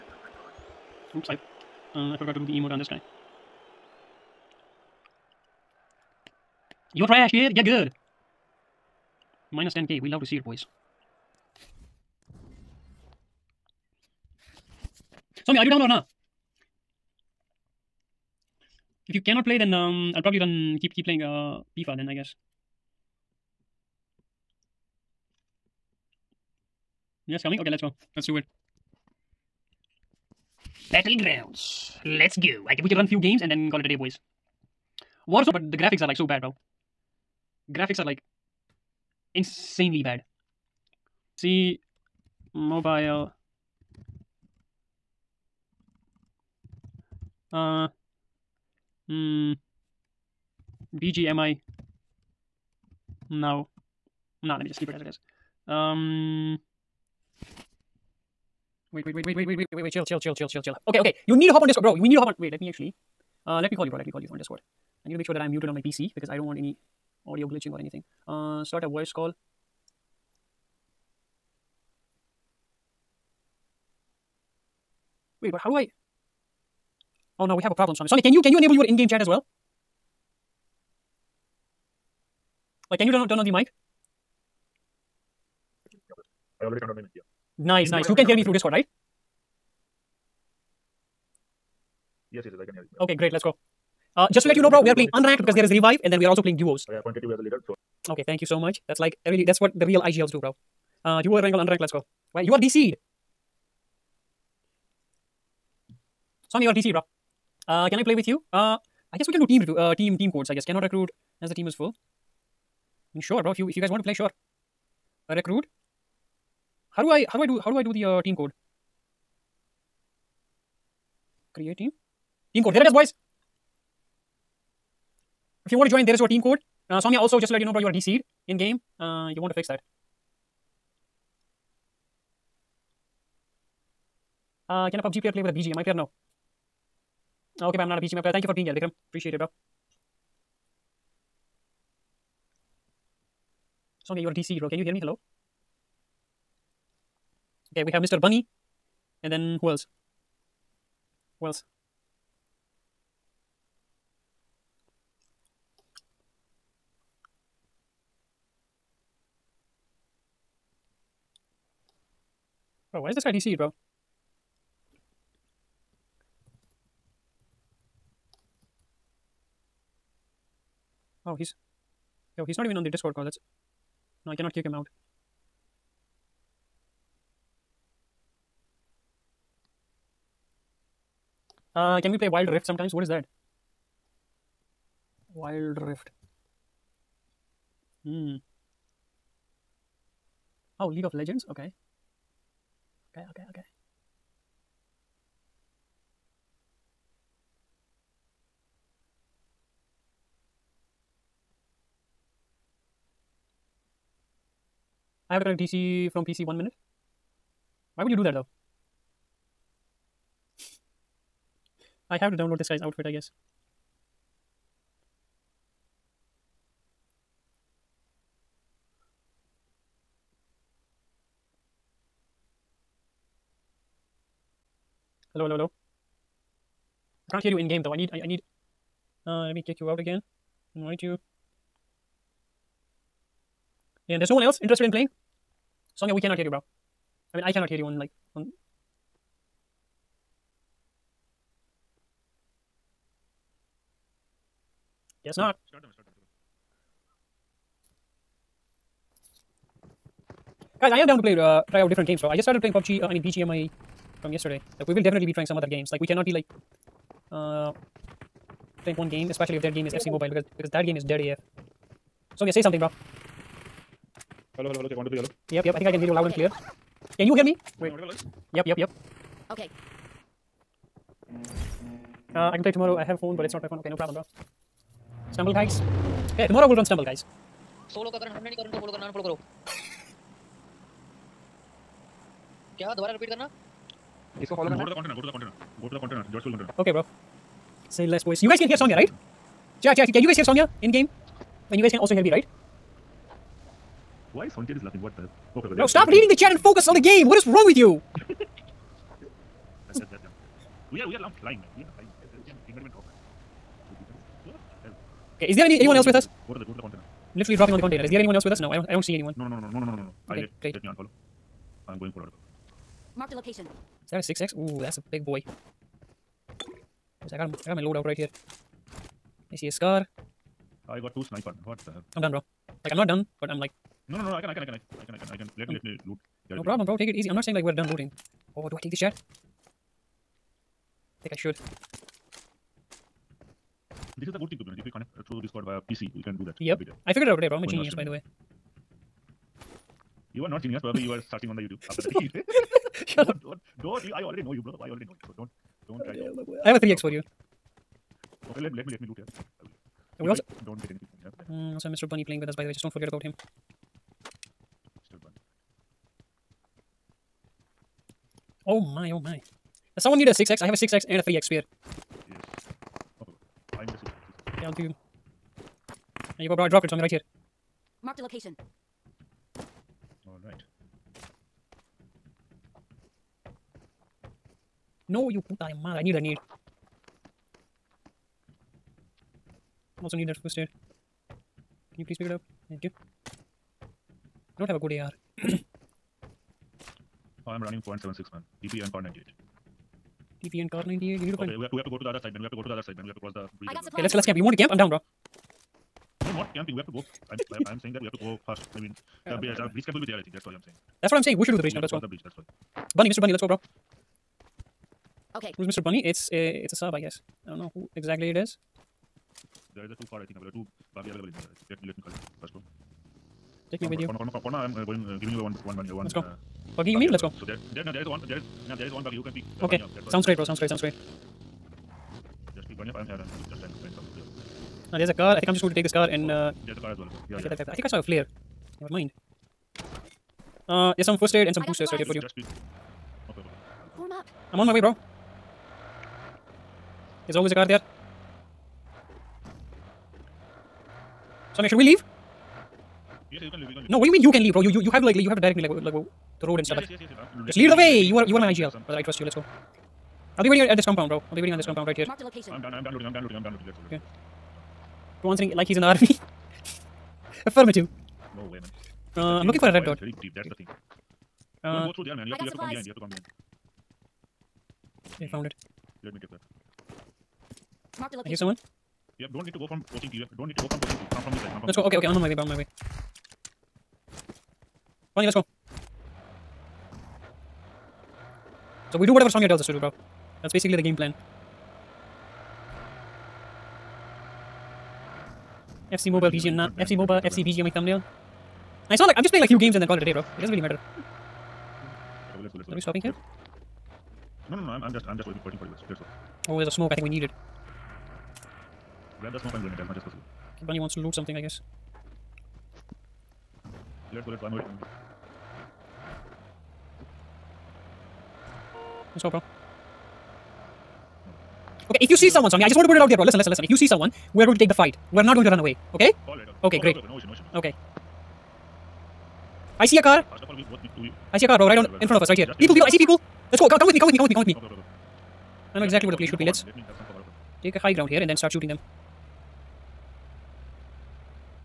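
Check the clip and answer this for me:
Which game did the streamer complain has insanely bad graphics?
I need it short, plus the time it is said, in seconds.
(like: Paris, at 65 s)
Warzone, at 35 s.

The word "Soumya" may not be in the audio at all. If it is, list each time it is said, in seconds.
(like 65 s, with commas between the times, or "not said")
144 s, 288 s.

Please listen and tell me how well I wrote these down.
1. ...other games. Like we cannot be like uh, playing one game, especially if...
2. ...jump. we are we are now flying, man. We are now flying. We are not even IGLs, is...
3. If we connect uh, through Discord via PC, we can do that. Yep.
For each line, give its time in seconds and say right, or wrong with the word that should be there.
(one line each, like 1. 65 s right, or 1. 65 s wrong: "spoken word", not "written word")
1. 255 s right
2. 300 s wrong: "Okay", not "IGLs"
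3. 334 s right.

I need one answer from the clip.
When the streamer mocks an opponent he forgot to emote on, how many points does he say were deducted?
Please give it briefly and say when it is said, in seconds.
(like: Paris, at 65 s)
10k, at 9 s.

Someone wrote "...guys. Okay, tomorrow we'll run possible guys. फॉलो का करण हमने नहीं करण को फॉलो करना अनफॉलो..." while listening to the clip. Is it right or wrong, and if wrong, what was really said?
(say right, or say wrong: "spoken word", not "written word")
wrong: "stumble", not "possible".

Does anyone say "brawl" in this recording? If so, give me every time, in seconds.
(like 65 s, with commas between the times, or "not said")
not said.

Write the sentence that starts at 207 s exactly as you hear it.
Why would you do that though?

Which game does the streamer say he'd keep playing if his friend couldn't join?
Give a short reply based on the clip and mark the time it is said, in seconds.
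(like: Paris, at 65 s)
FIFA, at 21 s.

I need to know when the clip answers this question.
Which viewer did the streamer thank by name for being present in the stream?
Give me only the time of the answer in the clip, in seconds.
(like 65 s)
138 s.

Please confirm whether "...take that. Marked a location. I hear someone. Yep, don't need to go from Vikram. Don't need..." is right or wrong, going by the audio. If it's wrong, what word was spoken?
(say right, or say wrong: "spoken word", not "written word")
wrong: "Pochinki", not "Vikram".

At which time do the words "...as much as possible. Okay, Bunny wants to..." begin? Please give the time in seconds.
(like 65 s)
499 s.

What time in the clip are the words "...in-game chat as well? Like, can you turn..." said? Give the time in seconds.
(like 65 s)
78 s.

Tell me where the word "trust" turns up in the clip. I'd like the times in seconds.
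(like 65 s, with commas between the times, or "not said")
449 s.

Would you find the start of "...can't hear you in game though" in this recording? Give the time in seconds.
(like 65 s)
227 s.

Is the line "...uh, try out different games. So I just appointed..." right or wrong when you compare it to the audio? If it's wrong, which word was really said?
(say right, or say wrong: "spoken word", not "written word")
wrong: "started", not "appointed".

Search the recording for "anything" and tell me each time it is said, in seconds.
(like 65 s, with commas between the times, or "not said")
67 s, 350 s.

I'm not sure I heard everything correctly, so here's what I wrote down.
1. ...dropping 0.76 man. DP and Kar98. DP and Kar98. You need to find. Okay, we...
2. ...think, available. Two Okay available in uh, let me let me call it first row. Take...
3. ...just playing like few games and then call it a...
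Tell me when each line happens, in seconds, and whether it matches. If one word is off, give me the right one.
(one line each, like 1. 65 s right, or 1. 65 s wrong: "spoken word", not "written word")
1. 387 s wrong: "running", not "dropping"
2. 410 s wrong: "Barbie", not "Okay"
3. 489 s right.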